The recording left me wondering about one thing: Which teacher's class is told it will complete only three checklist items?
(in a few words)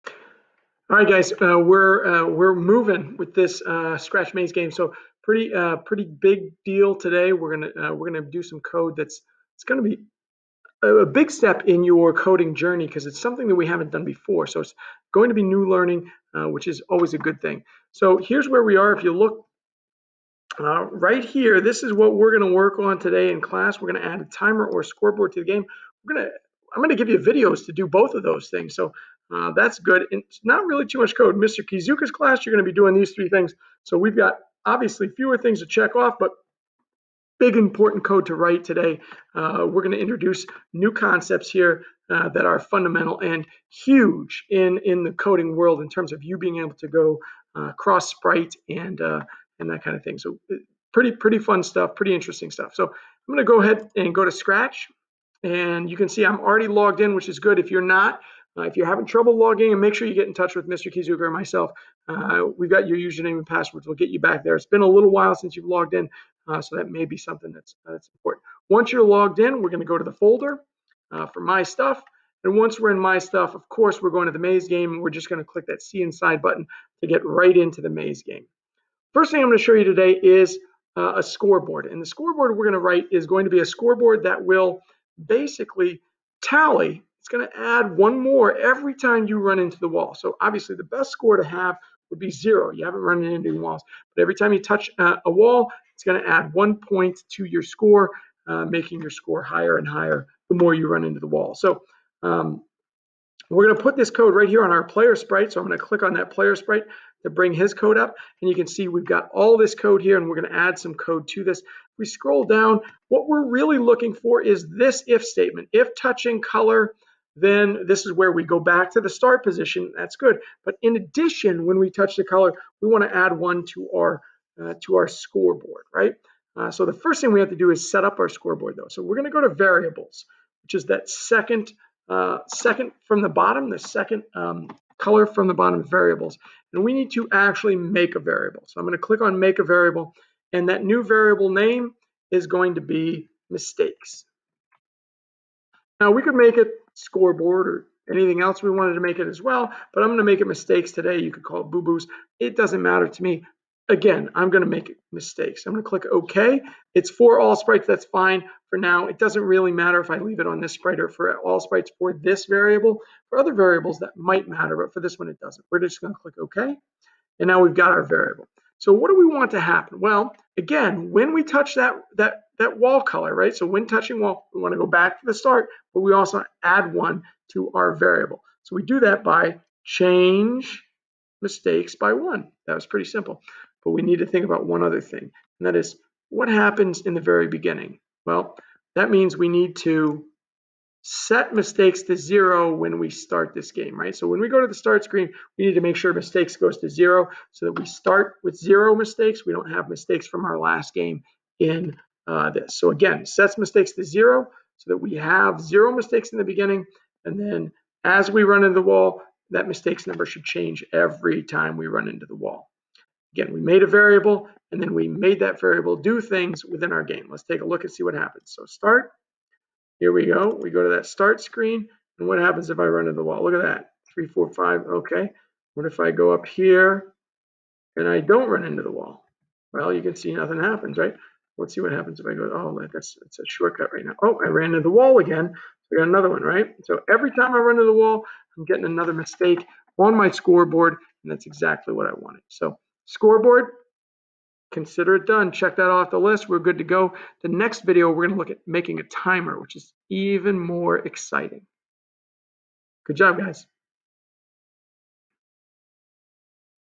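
Mr. Kizuka's class.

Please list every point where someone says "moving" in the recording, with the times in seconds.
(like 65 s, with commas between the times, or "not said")
2 s.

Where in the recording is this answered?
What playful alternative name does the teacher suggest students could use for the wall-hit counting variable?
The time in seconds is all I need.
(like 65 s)
151 s.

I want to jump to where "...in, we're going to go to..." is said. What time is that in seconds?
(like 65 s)
69 s.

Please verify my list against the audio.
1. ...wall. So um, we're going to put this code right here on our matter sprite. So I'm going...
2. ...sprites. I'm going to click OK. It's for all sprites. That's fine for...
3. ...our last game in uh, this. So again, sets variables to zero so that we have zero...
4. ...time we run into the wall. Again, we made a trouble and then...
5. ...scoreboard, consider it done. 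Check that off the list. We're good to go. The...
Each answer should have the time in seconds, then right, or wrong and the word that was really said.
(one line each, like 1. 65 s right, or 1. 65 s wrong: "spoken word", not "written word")
1. 101 s wrong: "player", not "matter"
2. 155 s wrong: "mistakes", not "sprites"
3. 200 s wrong: "mistakes", not "variables"
4. 211 s wrong: "variable", not "trouble"
5. 243 s right.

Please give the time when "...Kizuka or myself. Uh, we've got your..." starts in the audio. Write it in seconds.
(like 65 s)
60 s.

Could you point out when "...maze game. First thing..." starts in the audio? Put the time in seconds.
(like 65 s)
77 s.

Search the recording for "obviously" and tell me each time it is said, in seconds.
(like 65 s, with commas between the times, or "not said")
34 s, 90 s.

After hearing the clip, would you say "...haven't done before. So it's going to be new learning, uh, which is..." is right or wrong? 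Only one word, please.
right.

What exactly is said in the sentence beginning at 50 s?
So uh, pretty pretty fun stuff, pretty interesting stuff.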